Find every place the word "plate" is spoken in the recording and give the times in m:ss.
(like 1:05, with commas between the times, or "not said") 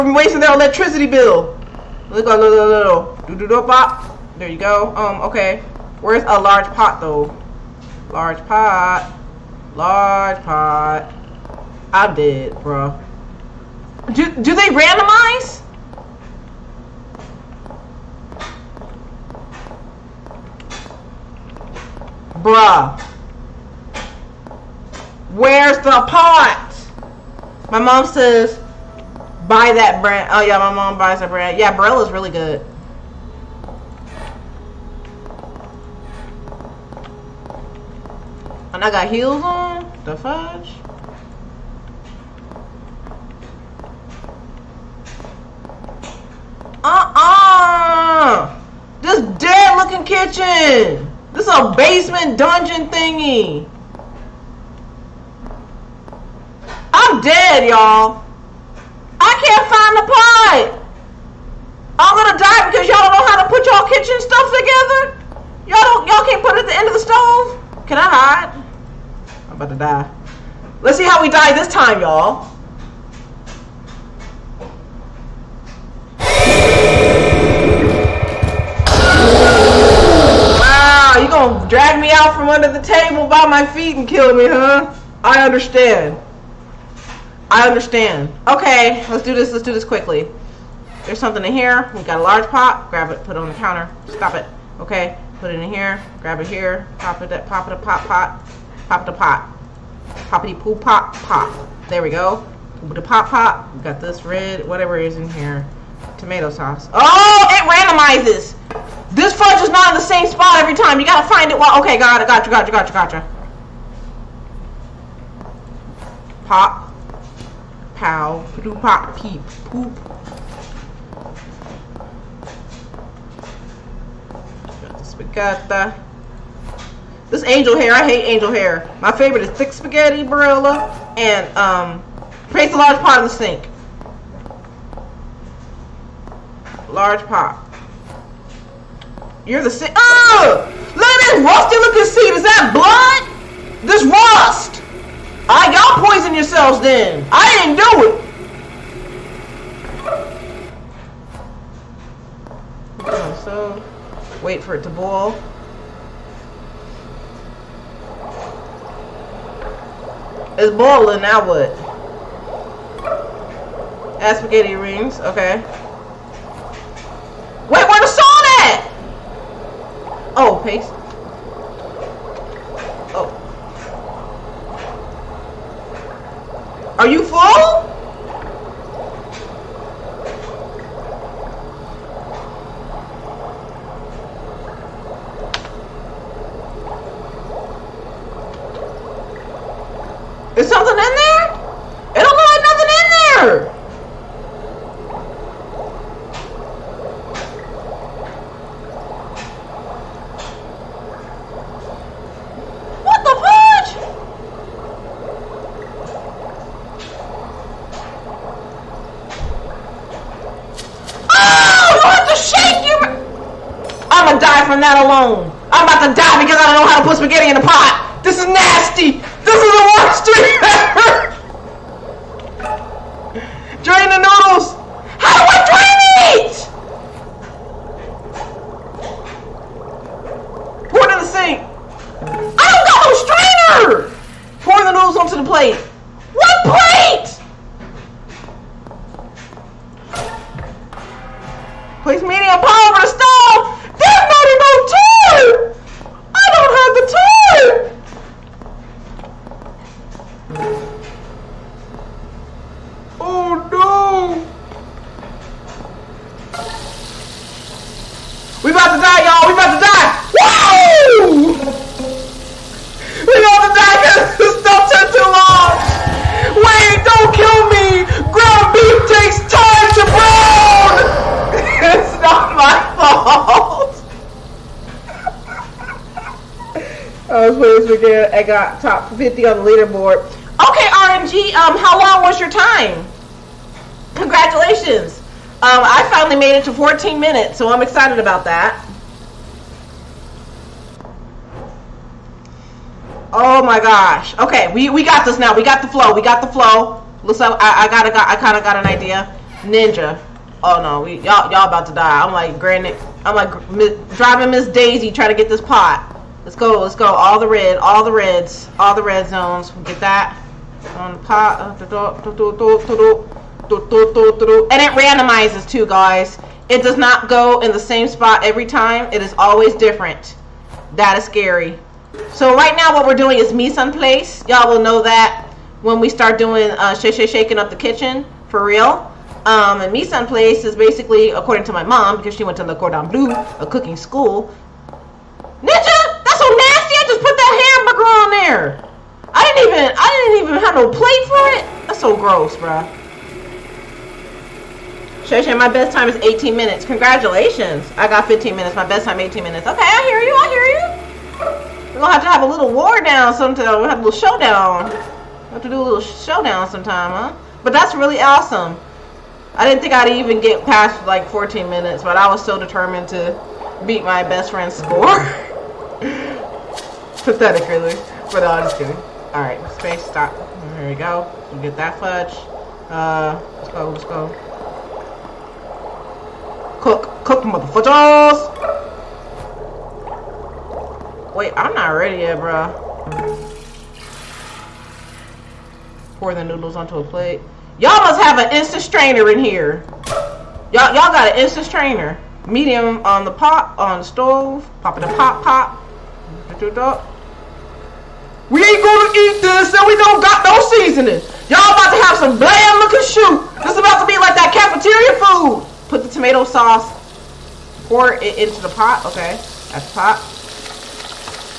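5:40, 6:27.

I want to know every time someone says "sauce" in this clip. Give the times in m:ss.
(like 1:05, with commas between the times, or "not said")
1:46, 6:46.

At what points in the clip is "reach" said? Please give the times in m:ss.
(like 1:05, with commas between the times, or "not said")
not said.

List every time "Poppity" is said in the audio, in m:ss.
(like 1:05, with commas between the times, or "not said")
1:40.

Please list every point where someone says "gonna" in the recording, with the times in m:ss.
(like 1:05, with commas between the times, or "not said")
1:02, 5:52, 6:38.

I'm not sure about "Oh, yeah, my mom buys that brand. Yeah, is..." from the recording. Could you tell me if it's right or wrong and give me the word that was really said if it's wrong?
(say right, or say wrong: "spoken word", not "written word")
right.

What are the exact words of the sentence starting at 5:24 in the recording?
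Y'all will know that when we start doing uh, sh shaking up the kitchen for real.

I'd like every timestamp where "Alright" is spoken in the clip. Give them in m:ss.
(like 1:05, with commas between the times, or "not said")
6:09.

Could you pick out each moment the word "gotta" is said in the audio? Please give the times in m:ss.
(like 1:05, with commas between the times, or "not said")
1:51.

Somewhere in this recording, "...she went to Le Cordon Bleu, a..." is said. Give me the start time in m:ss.
5:32.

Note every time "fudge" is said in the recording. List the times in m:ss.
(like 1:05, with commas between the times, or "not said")
0:40, 1:49, 6:11.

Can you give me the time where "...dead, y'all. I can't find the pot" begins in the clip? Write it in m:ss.
0:57.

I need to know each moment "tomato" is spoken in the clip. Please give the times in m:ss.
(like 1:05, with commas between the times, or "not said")
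1:46, 6:46.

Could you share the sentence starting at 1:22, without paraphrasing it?
out from under the table by my feet and kill me, huh?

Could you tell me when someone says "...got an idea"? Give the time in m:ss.
4:58.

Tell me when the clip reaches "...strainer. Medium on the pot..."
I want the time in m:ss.
6:31.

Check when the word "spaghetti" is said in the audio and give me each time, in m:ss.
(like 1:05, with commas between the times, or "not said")
2:05, 2:09, 2:44.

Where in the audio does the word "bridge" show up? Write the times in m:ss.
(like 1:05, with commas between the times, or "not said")
not said.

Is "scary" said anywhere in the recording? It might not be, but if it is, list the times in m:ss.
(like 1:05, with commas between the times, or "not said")
5:21.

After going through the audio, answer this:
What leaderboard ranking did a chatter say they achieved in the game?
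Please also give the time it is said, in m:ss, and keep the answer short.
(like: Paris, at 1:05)
top 50, at 4:38.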